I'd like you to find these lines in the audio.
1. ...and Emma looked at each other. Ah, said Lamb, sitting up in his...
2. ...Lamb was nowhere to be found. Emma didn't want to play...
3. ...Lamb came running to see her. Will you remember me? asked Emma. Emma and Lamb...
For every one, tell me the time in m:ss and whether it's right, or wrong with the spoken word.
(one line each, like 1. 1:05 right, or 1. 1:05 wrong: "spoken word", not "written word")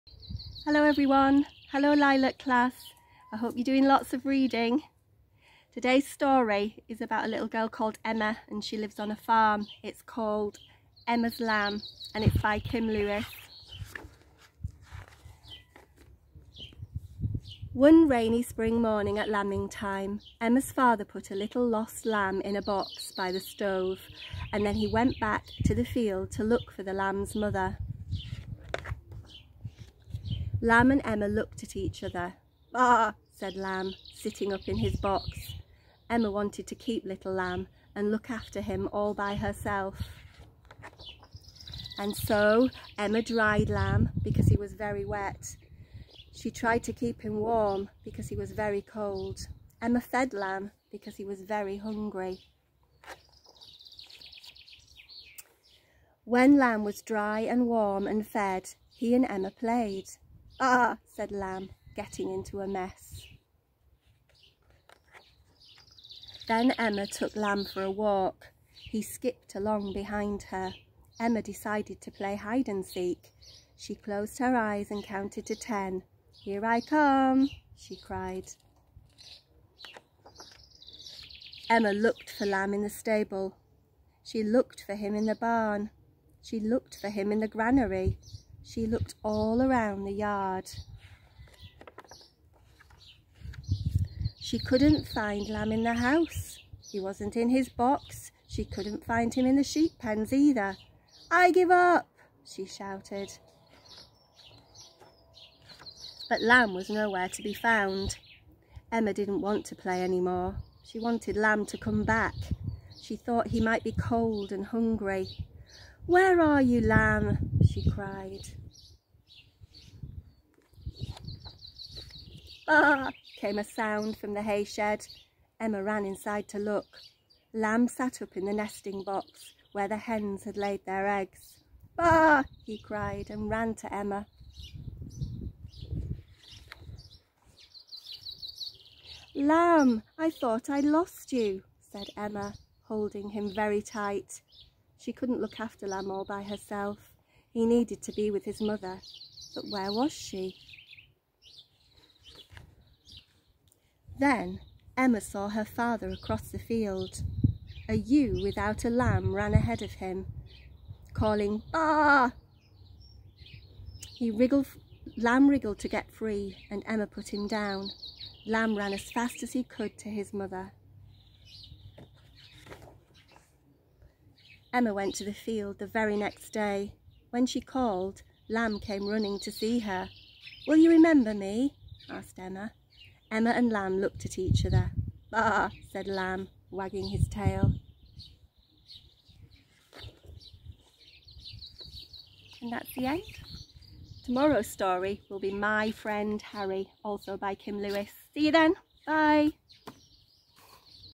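1. 0:30 right
2. 1:46 right
3. 2:58 right.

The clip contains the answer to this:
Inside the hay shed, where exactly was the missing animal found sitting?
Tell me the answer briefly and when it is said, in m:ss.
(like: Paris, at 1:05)
The nesting box, at 2:08.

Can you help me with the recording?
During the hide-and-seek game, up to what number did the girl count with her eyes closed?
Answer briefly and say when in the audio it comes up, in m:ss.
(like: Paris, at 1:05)
10, at 1:15.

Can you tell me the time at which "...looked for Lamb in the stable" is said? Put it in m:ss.
1:21.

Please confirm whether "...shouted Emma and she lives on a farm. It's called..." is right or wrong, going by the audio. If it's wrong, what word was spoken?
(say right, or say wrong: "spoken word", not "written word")
wrong: "called", not "shouted".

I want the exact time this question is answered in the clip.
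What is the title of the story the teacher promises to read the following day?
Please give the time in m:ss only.
3:15.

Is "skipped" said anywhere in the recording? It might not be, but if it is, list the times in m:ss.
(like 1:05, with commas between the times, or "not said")
1:09.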